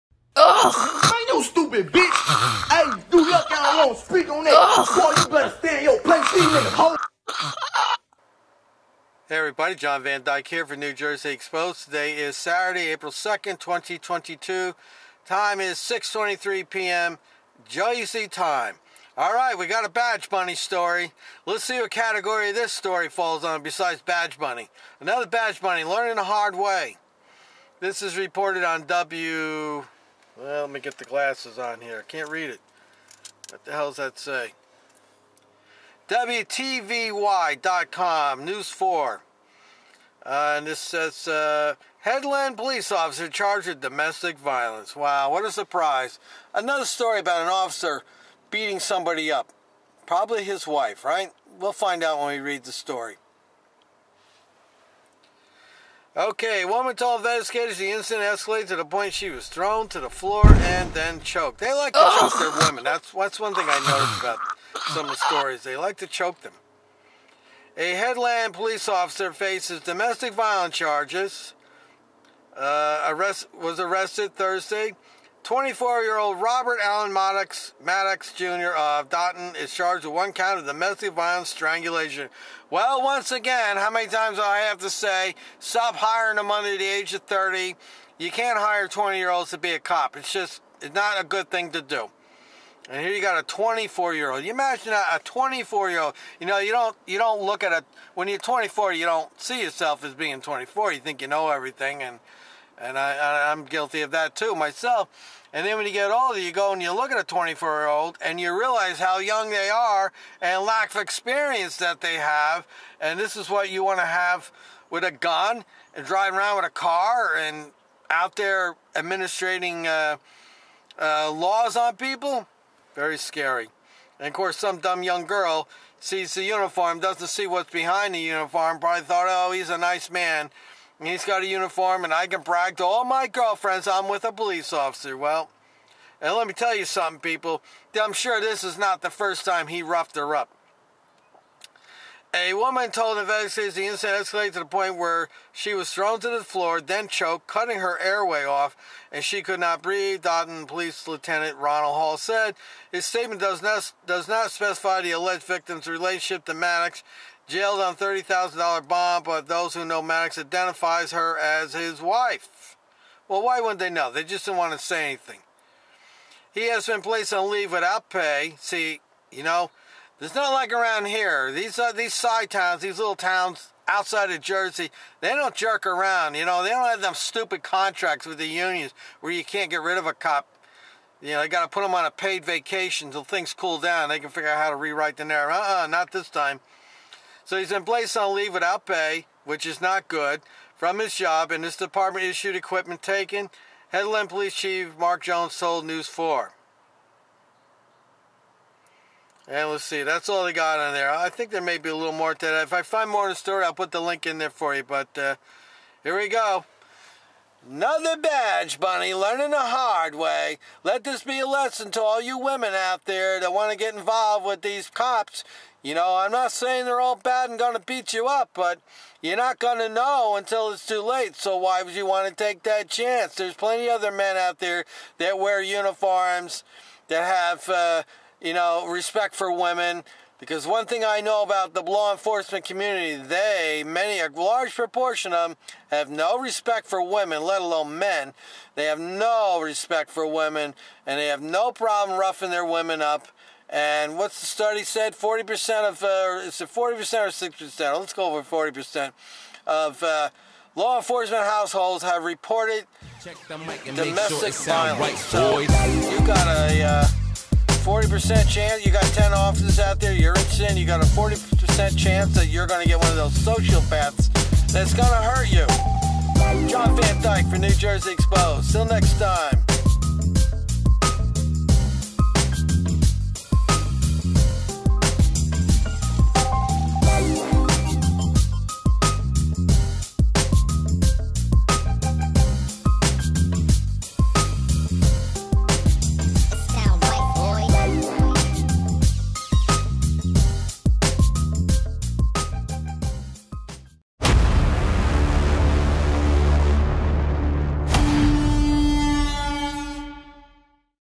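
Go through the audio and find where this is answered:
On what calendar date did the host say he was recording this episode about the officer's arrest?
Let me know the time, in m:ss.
0:12.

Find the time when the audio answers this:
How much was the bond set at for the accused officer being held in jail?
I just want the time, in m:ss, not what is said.
2:37.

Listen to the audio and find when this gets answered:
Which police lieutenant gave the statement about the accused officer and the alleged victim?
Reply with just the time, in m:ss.
2:31.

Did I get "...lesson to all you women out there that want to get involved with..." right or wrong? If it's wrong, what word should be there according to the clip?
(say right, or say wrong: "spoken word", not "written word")
right.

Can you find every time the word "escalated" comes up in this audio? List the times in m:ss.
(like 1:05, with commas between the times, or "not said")
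0:58, 2:24.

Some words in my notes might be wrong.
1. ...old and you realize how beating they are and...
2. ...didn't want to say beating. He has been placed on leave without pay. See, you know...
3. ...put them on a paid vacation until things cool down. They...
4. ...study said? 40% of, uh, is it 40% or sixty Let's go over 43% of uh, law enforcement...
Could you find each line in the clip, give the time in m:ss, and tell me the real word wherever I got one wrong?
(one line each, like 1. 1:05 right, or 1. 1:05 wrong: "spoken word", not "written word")
1. 1:47 wrong: "young", not "beating"
2. 2:44 wrong: "anything", not "beating"
3. 3:01 right
4. 4:04 wrong: "40", not "43".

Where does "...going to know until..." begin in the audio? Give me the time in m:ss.
3:39.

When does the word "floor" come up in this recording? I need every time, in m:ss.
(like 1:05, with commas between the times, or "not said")
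1:00, 2:26.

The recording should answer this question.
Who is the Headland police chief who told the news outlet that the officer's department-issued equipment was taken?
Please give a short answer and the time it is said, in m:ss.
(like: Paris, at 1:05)
Mark Jones, at 3:14.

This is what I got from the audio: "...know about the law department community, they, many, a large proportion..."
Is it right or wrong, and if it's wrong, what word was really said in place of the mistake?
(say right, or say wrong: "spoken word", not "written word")
wrong: "enforcement", not "department".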